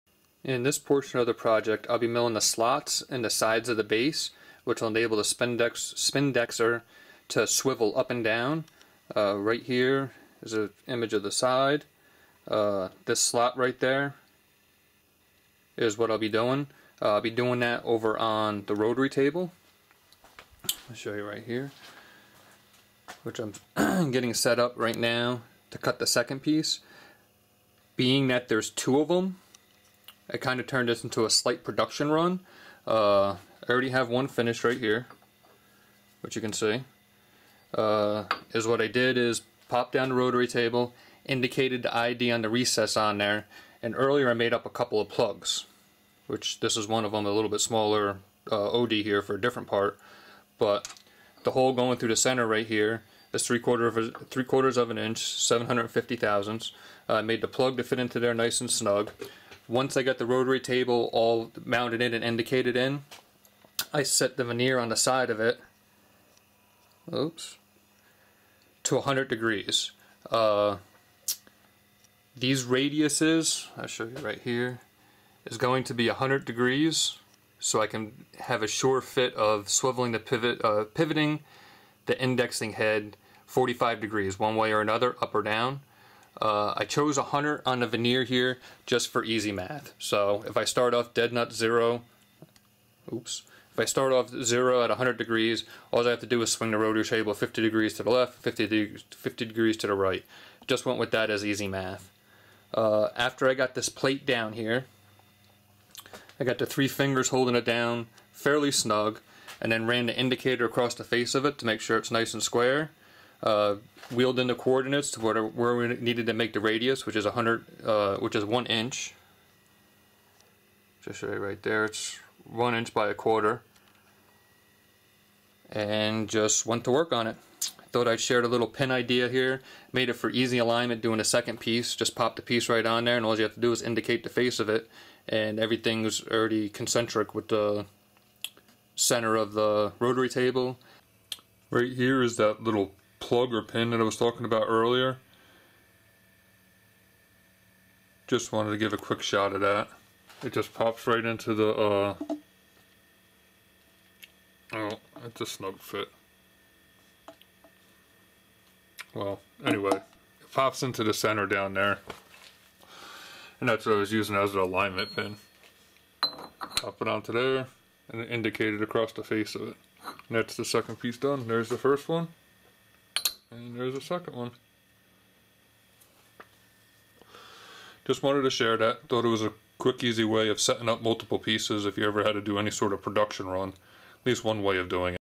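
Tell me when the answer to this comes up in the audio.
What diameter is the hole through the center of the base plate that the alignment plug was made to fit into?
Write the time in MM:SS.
00:54.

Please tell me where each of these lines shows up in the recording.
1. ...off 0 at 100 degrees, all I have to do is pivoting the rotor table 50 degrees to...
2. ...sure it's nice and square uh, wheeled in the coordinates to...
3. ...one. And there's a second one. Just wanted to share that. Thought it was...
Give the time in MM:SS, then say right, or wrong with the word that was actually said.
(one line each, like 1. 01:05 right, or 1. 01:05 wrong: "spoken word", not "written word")
1. 01:34 wrong: "swing", not "pivoting"
2. 01:51 right
3. 02:52 right.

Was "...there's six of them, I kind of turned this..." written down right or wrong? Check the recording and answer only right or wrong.
wrong.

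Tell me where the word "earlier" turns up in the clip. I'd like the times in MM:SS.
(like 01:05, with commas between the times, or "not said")
00:43, 02:24.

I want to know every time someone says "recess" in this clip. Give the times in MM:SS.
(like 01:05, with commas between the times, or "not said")
00:42.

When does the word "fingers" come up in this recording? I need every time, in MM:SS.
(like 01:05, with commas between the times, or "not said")
01:46.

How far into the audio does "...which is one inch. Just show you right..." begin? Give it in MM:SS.
01:58.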